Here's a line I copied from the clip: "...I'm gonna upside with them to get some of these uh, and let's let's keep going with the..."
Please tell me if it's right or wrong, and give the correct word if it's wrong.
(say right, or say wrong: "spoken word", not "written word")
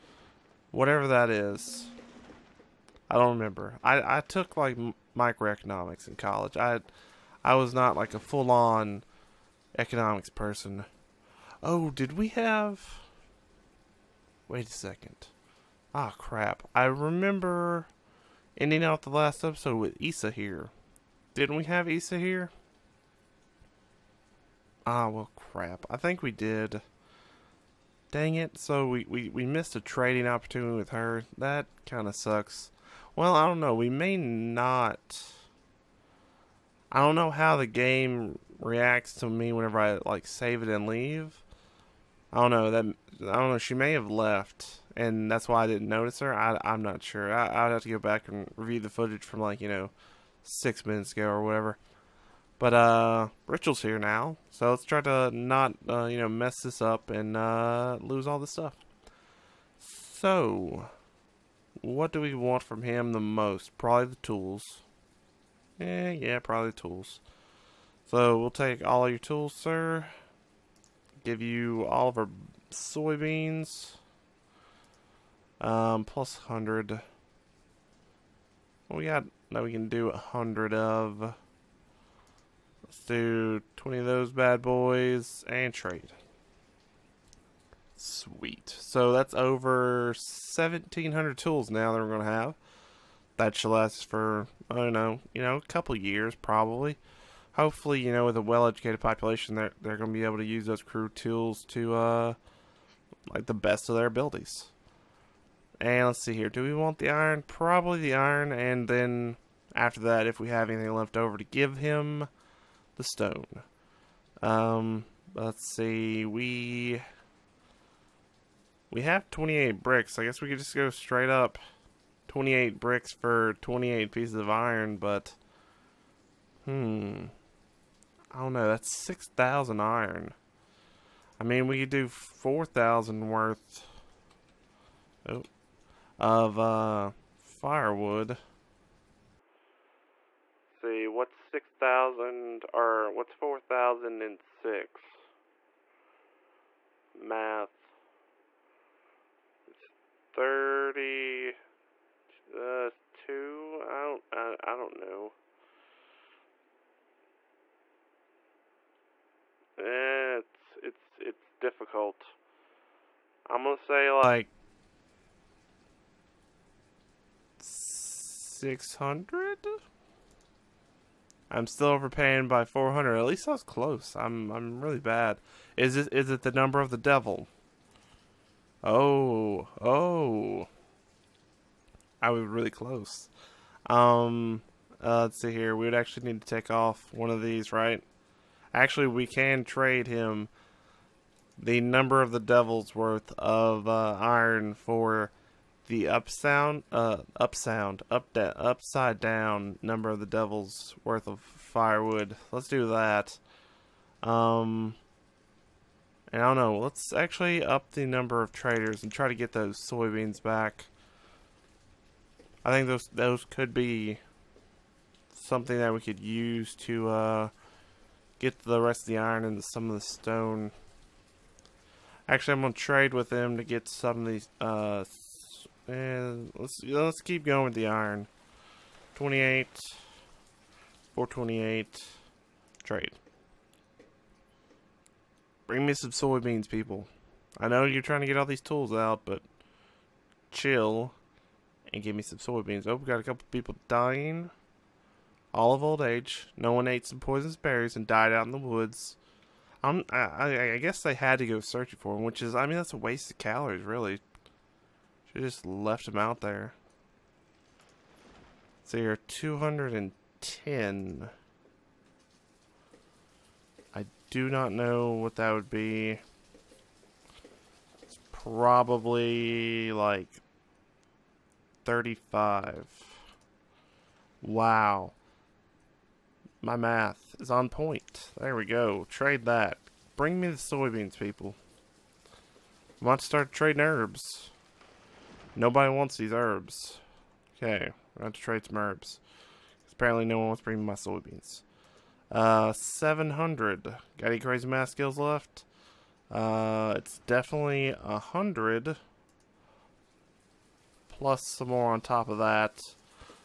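wrong: "trade", not "upside".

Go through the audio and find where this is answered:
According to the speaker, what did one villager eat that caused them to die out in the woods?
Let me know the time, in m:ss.
4:07.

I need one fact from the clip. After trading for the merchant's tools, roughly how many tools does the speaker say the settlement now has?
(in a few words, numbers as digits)
Over 1,700.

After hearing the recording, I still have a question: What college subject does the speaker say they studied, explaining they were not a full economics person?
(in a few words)
Microeconomics.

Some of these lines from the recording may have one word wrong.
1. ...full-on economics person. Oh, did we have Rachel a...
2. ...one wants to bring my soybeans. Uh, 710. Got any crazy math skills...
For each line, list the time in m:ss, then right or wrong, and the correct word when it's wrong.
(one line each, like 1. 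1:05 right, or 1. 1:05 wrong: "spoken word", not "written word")
1. 0:08 wrong: "Wait", not "Rachel"
2. 4:50 wrong: "700", not "710".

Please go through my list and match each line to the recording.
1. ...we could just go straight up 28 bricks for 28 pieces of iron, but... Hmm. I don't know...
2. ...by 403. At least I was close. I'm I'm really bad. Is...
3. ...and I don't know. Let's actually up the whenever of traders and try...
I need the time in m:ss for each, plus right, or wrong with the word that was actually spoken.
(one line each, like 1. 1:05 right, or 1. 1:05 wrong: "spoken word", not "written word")
1. 2:00 right
2. 2:52 wrong: "400", not "403"
3. 3:26 wrong: "number", not "whenever".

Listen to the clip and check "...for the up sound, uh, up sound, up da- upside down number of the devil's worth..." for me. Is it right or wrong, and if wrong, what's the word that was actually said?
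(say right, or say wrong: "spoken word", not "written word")
right.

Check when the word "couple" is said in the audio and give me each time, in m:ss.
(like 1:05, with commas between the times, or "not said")
1:35, 4:03.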